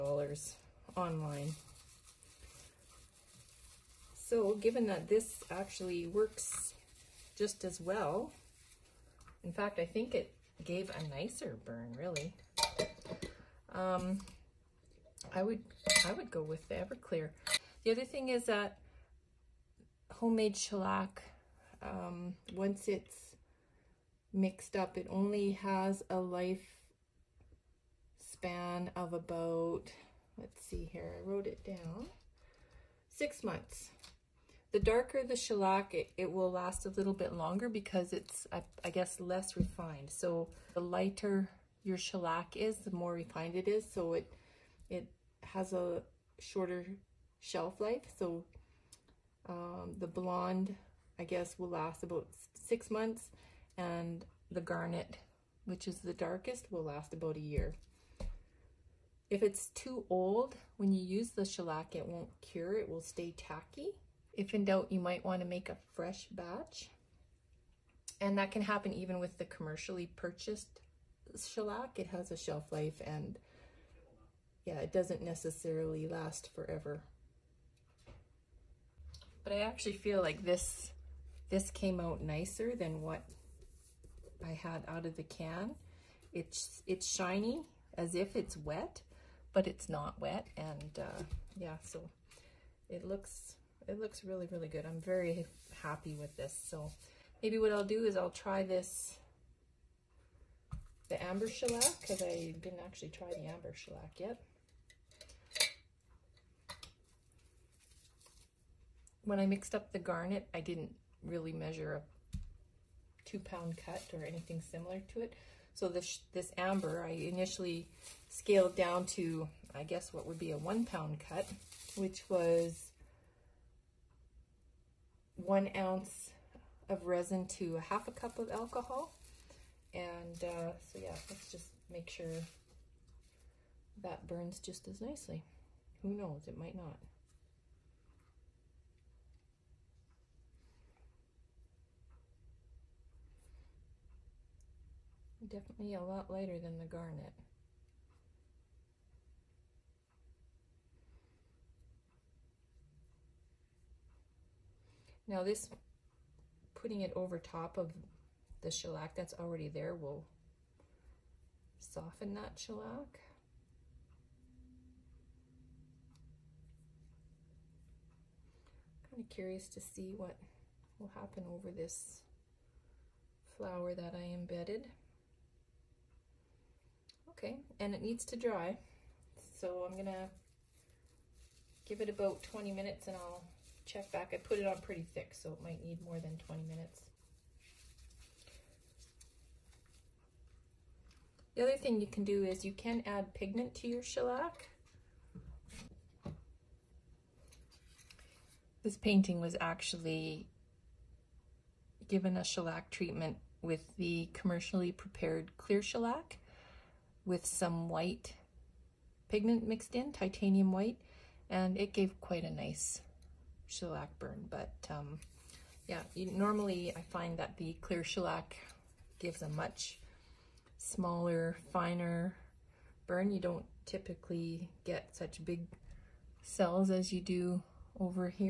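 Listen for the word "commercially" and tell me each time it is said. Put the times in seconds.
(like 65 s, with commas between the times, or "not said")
69 s, 204 s.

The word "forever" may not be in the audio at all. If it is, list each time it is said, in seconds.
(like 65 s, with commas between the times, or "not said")
76 s.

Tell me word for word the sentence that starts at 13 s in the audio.
Um, I would, I would go with the Everclear.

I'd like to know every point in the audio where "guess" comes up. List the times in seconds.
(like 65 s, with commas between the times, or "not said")
38 s, 51 s, 119 s.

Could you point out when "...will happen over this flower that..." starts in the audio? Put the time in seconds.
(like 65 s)
170 s.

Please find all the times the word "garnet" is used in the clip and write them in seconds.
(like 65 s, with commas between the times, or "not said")
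54 s, 109 s, 146 s.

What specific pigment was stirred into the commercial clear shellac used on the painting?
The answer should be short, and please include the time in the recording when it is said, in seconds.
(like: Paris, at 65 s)
titanium white, at 210 s.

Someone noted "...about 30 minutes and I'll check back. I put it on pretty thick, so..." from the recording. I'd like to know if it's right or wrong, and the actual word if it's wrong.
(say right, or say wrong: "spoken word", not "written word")
wrong: "20", not "30".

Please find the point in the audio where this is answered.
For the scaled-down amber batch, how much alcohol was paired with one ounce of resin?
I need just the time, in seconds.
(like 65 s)
127 s.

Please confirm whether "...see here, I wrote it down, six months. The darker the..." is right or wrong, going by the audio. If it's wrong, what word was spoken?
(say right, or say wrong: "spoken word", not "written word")
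right.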